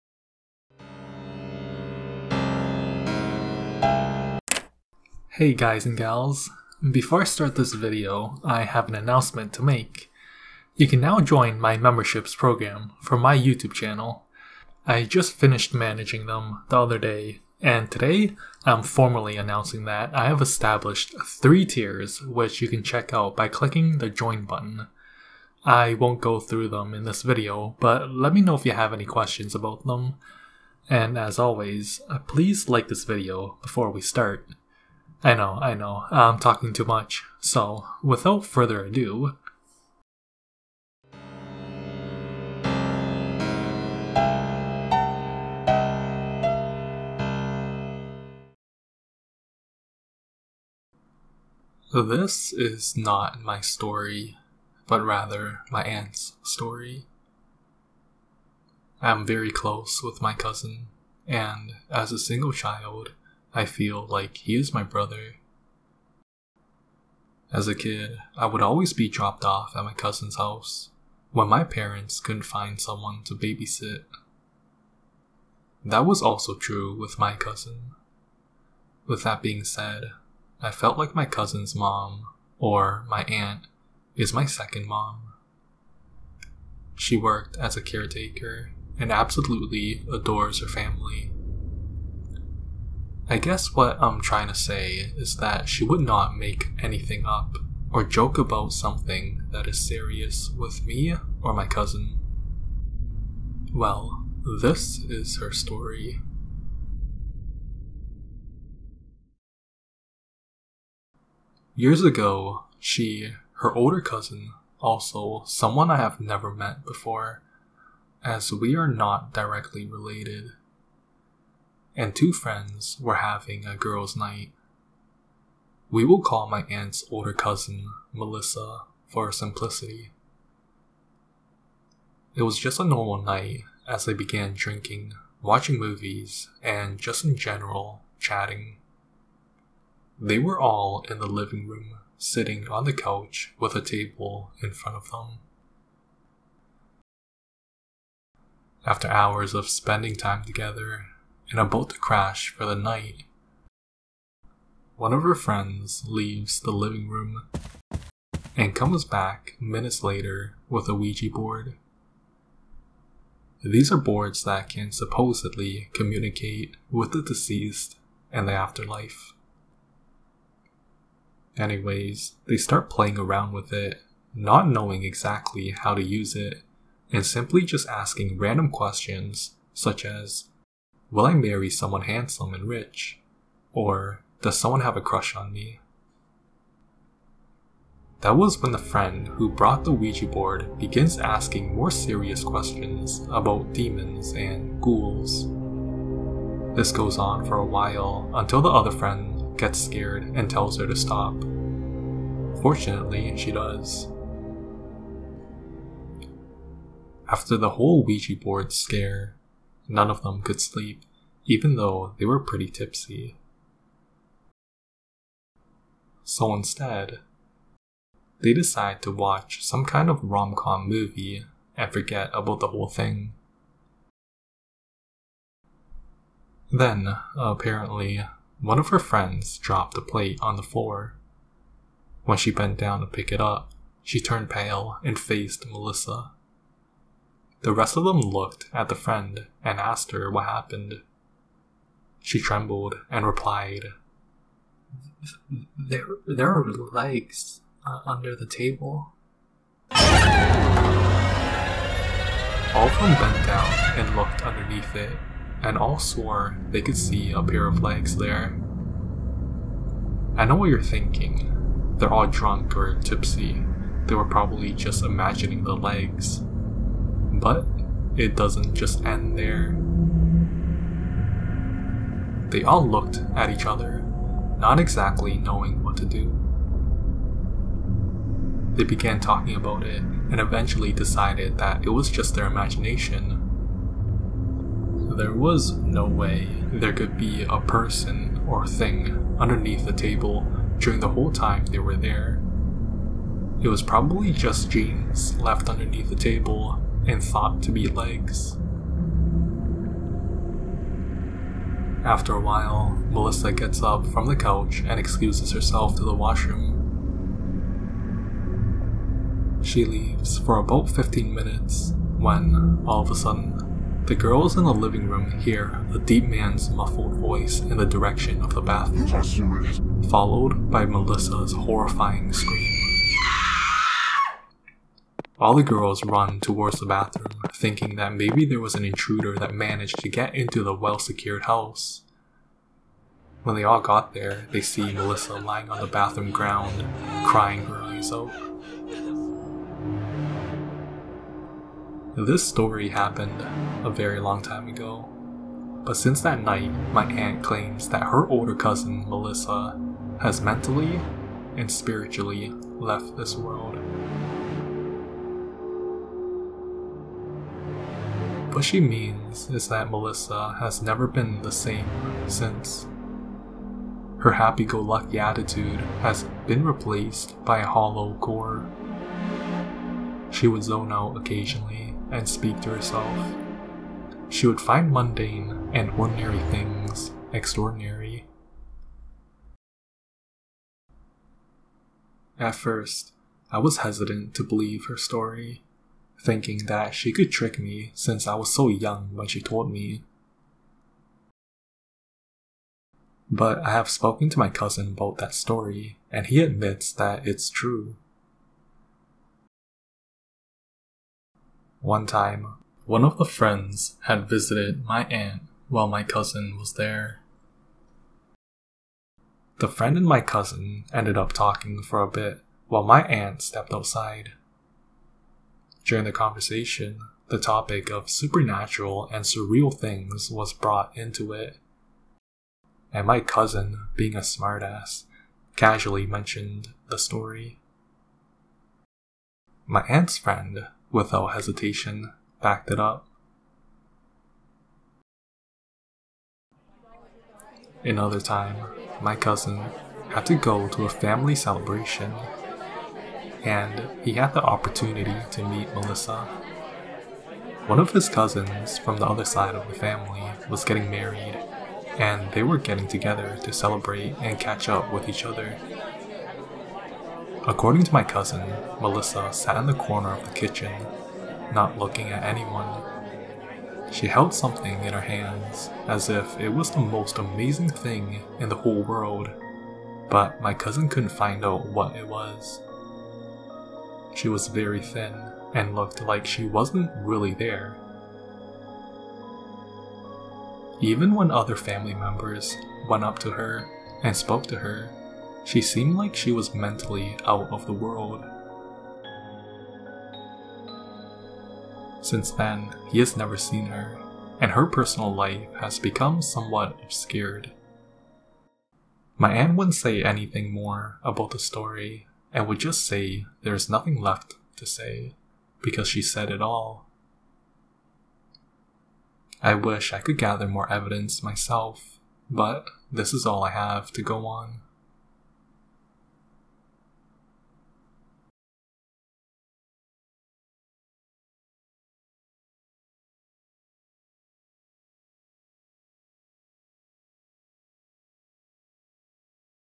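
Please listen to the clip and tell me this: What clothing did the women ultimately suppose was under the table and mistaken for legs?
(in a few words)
Jeans.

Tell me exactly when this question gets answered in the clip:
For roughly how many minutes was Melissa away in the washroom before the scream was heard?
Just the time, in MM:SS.
05:10.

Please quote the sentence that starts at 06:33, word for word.
But I have spoken to my cousin about that story, and he admits that it's true.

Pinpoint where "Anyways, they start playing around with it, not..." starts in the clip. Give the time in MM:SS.
02:51.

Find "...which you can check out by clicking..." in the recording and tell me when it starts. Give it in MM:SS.
00:22.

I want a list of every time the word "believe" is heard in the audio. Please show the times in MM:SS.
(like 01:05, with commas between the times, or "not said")
06:24.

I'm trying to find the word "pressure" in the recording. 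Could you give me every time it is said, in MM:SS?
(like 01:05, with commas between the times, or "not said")
not said.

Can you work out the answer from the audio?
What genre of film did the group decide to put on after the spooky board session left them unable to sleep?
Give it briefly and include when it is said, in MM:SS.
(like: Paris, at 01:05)
Rom com, at 03:40.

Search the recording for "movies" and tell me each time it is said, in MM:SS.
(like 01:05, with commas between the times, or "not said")
02:15, 03:40.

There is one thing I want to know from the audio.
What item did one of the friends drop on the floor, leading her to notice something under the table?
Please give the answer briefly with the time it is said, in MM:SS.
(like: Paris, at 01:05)
A plate, at 03:50.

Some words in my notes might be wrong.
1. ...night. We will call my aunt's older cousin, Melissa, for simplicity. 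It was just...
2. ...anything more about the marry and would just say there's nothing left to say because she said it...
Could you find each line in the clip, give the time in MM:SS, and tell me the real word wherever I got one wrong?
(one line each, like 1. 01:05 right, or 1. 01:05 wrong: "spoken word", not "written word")
1. 02:04 right
2. 08:20 wrong: "story", not "marry".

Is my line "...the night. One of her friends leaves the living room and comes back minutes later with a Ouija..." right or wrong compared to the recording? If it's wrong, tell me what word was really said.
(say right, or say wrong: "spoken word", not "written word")
right.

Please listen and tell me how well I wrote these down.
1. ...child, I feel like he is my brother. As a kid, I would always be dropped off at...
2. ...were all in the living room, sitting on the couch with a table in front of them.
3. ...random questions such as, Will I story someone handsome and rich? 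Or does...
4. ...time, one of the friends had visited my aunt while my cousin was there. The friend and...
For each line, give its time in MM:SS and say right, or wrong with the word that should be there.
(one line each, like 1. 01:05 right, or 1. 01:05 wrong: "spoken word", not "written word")
1. 01:02 right
2. 02:20 right
3. 02:58 wrong: "marry", not "story"
4. 06:42 right.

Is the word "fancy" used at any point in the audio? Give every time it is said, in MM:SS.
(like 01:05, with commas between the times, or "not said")
not said.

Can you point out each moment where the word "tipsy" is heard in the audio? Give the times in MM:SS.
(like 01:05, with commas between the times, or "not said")
03:32, 04:22.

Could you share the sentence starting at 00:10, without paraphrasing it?
You can now join my memberships program for my YouTube channel.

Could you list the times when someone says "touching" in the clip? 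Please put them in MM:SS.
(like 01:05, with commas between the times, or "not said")
not said.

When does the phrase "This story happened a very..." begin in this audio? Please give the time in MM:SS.
05:42.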